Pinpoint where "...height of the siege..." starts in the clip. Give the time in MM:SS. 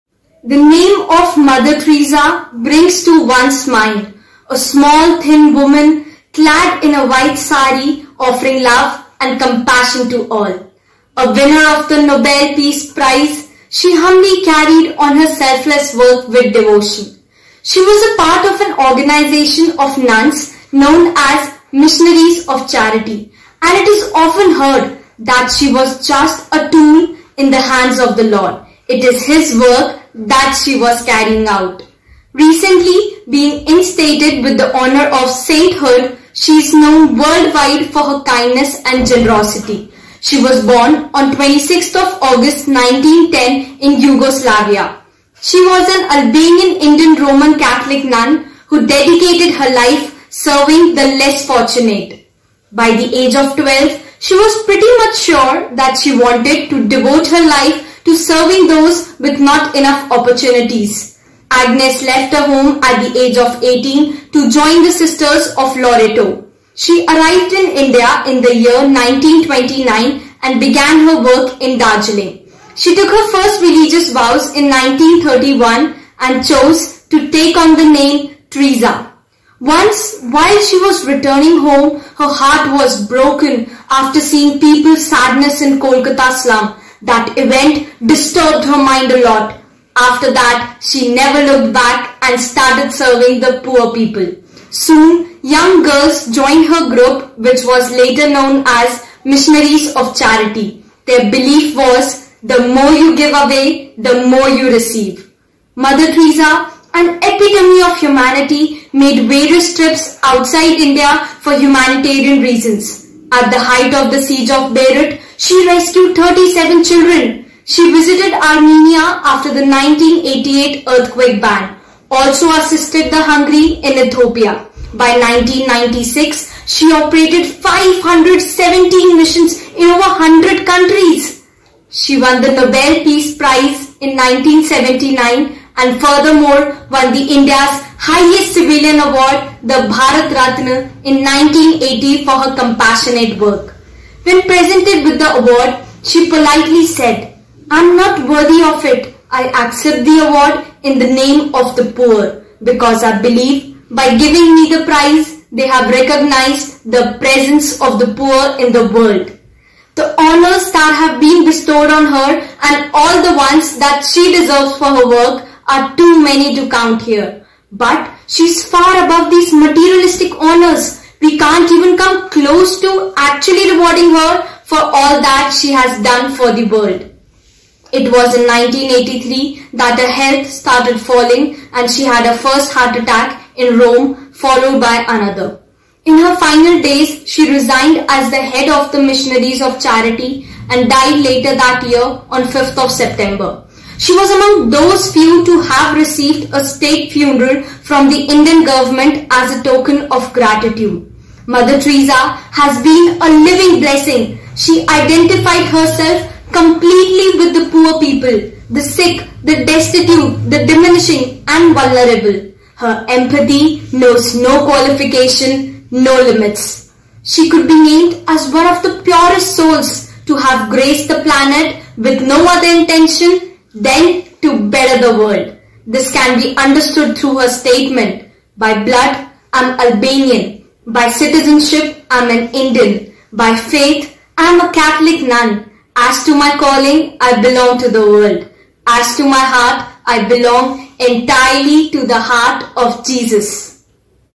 01:53.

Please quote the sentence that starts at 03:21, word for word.
Mother Teresa has been a living blessing.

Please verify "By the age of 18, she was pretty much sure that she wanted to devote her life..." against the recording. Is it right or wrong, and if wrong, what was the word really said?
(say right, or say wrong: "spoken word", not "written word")
wrong: "12", not "18".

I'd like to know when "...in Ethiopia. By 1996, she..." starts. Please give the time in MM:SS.
02:03.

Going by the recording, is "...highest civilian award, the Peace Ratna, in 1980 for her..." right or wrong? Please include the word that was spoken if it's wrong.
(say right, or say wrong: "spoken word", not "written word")
wrong: "Bharat", not "Peace".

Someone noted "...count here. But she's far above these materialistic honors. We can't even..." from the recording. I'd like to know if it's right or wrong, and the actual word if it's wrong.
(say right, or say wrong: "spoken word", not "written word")
right.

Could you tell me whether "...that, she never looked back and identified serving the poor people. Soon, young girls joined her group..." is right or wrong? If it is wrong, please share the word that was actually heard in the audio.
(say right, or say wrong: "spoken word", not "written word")
wrong: "started", not "identified".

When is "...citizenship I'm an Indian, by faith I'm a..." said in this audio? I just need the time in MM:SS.
03:51.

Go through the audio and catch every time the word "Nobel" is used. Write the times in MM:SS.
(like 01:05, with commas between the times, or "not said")
00:12, 02:12.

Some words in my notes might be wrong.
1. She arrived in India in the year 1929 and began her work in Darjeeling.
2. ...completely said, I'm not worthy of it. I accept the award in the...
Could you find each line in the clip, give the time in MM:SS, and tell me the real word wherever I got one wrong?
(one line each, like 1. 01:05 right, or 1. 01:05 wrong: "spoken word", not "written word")
1. 01:06 right
2. 02:26 wrong: "politely", not "completely".